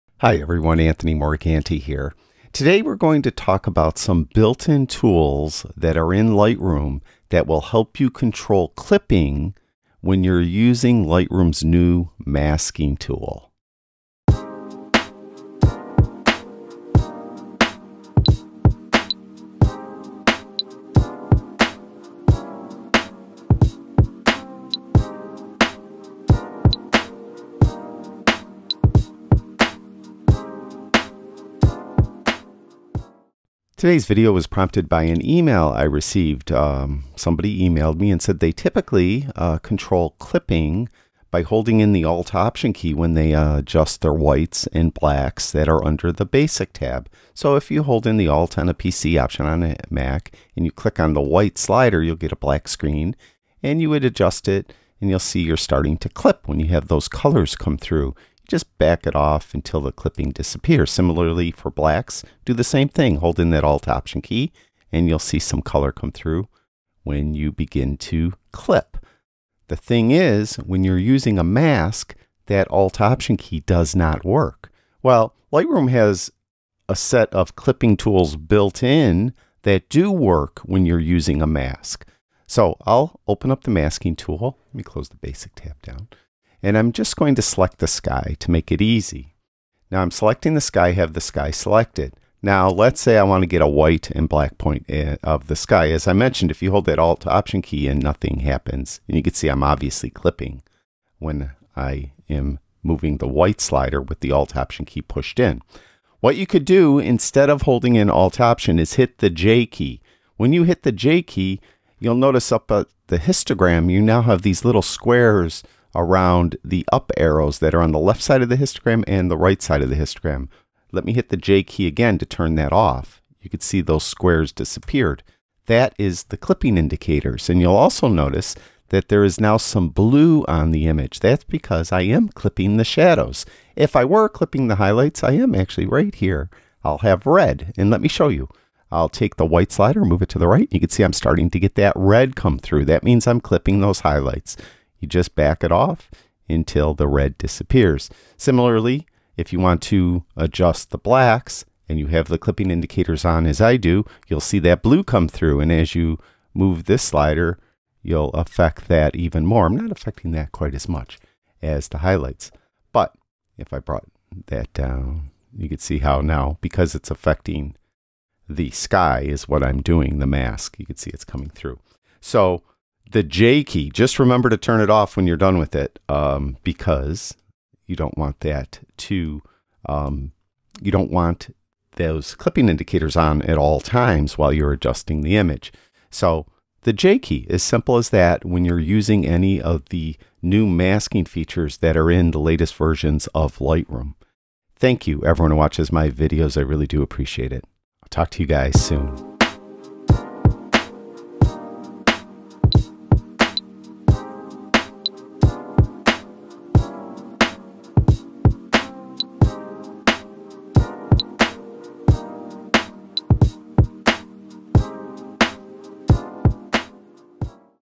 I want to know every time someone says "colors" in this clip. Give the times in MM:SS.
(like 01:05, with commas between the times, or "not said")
00:57, 01:05.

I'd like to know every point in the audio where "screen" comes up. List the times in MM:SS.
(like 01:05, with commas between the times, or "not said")
00:52.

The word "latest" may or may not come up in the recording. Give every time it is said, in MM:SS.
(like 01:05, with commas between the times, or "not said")
03:12.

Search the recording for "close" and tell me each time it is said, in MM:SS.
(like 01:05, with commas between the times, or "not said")
01:24.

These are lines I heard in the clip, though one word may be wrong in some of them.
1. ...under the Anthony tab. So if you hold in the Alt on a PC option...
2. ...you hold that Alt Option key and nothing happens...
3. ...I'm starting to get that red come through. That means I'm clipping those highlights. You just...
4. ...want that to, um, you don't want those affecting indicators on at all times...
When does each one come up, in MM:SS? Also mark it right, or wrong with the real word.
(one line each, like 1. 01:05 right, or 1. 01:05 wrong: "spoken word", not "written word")
1. 00:45 wrong: "Basic", not "Anthony"
2. 01:36 right
3. 02:21 right
4. 02:58 wrong: "clipping", not "affecting".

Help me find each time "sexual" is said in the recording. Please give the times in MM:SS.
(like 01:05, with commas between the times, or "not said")
not said.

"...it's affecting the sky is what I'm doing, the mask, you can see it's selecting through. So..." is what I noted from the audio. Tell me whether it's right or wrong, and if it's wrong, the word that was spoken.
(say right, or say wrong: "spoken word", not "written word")
wrong: "coming", not "selecting".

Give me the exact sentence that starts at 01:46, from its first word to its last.
What you could do instead of holding in Alt Option is hit the J key.